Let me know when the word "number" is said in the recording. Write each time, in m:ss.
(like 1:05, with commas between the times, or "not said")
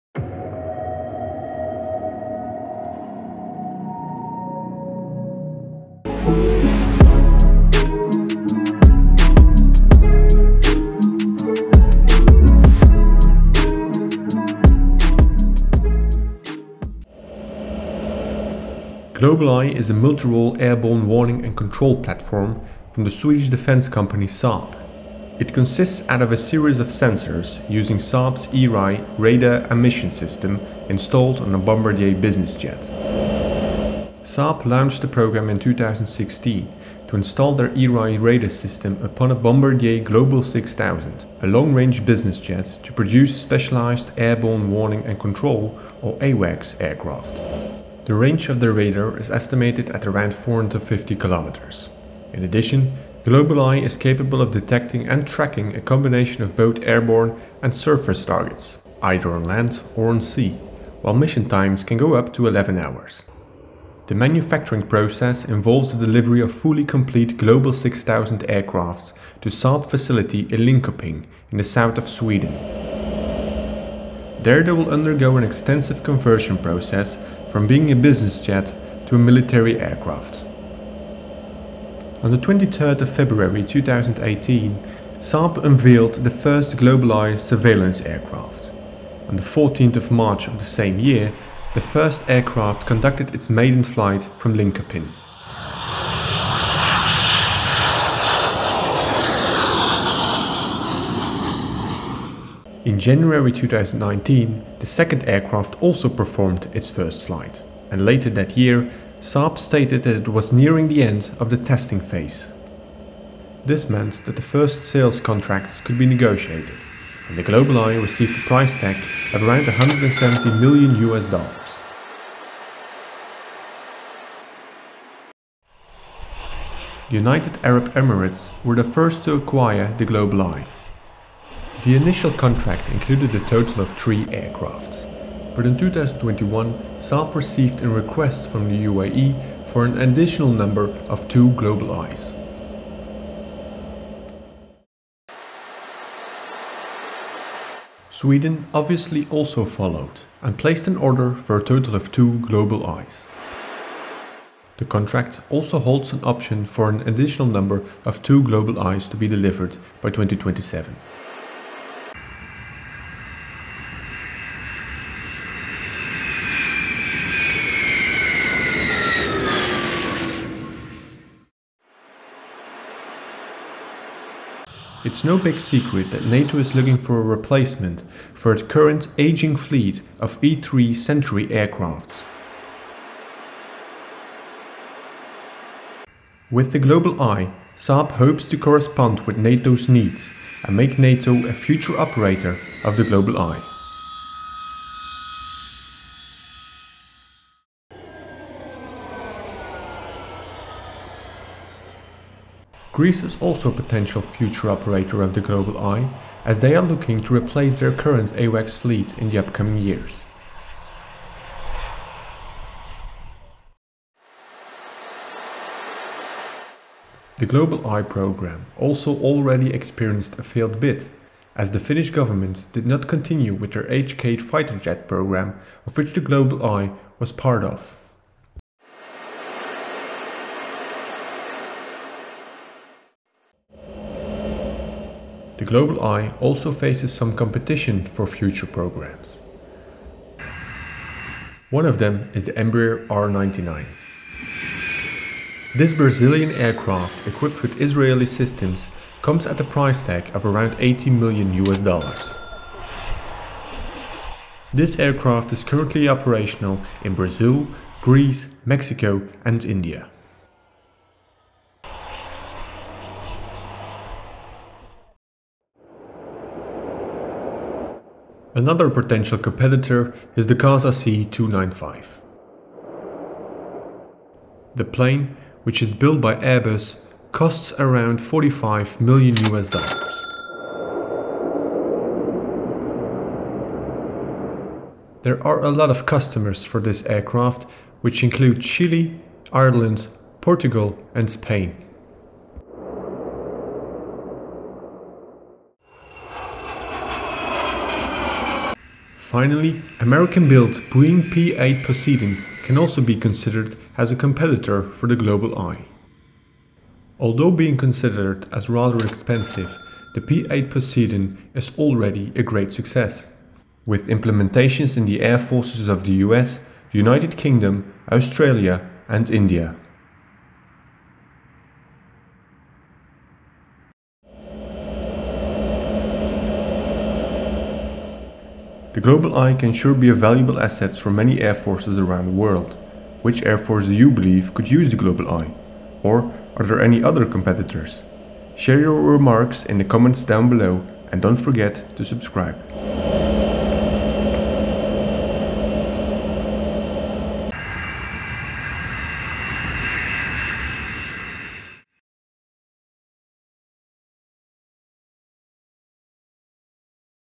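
2:20, 2:37.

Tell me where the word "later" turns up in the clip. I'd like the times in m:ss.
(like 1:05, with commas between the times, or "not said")
1:48.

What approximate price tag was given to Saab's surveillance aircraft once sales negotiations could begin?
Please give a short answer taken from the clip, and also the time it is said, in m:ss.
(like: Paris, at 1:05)
170 million US dollars, at 1:59.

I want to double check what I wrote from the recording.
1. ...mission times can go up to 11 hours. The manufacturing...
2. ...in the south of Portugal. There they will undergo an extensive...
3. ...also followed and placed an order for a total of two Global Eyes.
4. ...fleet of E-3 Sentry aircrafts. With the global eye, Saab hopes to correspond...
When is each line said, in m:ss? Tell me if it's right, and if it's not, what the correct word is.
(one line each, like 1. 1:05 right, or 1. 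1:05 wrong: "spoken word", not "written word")
1. 1:01 right
2. 1:11 wrong: "Sweden", not "Portugal"
3. 2:29 right
4. 2:59 right.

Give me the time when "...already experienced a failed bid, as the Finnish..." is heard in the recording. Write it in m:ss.
3:39.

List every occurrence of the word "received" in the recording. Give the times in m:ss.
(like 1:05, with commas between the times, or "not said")
1:58, 2:17.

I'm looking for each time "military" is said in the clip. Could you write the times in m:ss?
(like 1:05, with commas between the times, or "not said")
1:19.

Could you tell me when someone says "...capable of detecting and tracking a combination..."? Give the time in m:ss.
0:53.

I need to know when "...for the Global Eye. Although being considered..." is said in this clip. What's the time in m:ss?
5:04.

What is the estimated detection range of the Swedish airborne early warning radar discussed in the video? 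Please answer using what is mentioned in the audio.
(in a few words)
450 kilometers.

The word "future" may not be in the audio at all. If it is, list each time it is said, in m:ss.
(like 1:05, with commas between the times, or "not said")
3:11, 3:24, 3:58.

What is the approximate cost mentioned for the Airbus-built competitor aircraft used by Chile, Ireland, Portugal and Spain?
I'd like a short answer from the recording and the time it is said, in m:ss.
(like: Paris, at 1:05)
45 million US dollars, at 4:38.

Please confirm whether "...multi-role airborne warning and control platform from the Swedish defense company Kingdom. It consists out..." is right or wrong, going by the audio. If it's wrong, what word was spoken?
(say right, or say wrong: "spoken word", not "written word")
wrong: "Saab", not "Kingdom".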